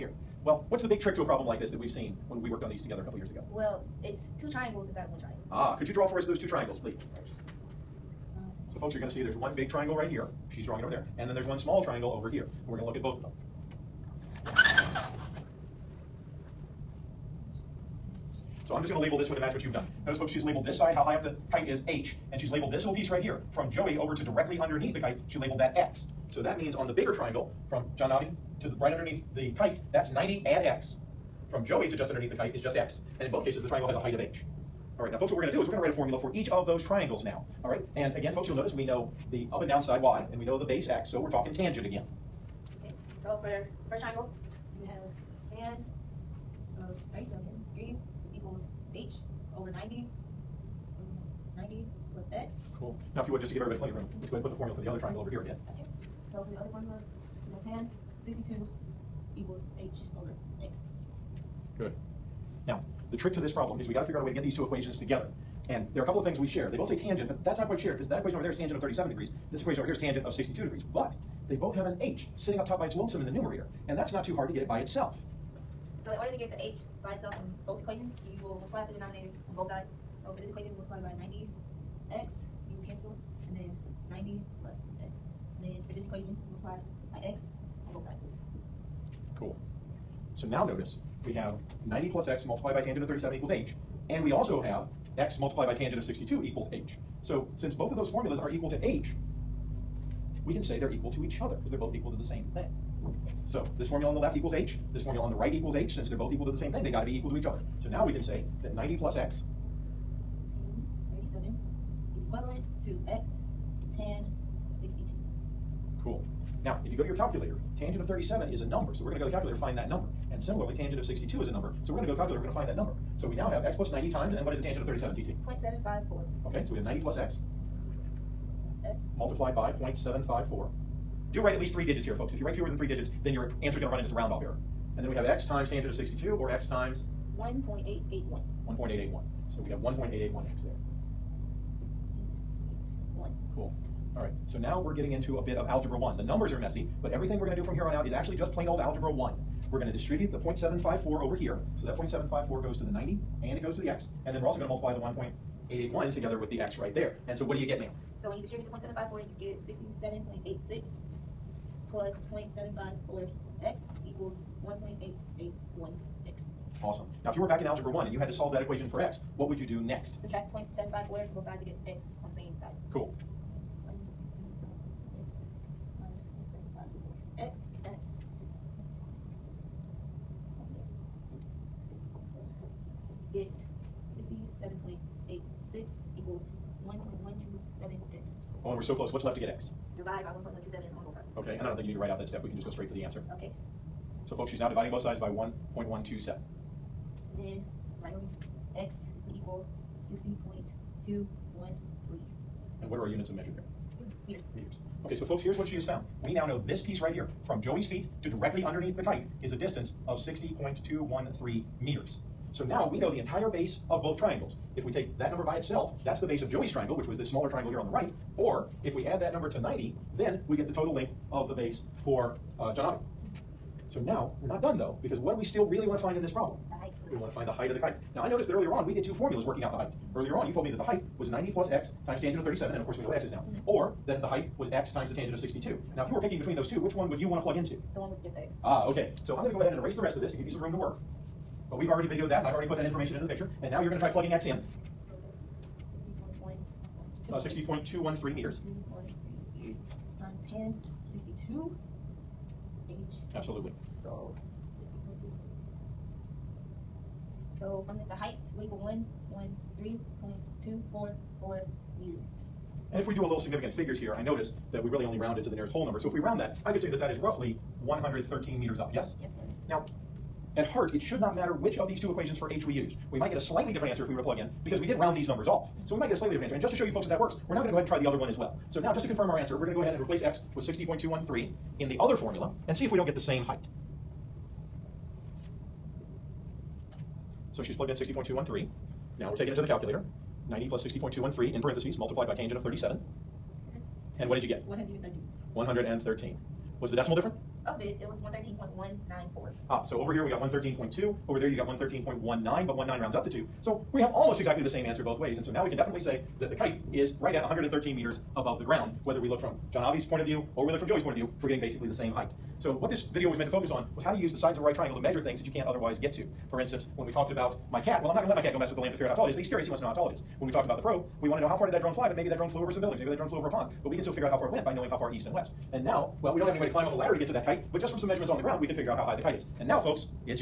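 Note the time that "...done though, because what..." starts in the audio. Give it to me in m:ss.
3:44.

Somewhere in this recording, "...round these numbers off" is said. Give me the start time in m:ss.
4:34.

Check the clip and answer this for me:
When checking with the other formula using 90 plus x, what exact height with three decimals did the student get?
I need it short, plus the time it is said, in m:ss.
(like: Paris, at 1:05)
113.194, at 4:58.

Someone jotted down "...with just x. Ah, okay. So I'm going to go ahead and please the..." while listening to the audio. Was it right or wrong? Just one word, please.
wrong.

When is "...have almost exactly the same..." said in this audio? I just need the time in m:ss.
5:04.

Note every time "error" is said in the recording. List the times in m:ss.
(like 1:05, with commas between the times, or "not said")
2:14.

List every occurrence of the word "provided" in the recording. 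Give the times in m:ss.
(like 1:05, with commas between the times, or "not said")
not said.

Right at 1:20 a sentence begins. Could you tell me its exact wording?
So for this equation, we multiply by 90x, these will cancel, and then 90 plus x.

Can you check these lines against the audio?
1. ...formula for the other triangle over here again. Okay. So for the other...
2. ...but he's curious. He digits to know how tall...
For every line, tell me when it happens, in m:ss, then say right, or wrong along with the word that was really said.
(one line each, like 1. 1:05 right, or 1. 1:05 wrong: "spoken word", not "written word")
1. 0:54 right
2. 5:19 wrong: "wants", not "digits".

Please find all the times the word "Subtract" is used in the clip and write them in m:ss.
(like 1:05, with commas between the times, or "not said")
2:50.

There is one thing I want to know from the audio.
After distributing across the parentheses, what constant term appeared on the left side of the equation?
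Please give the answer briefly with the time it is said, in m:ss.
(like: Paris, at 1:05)
67.86, at 2:40.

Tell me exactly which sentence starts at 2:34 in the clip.
And then we're also going to multiply the 1.881 together with the x right there.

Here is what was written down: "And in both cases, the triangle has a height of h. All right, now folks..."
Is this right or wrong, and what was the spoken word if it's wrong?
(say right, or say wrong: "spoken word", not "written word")
right.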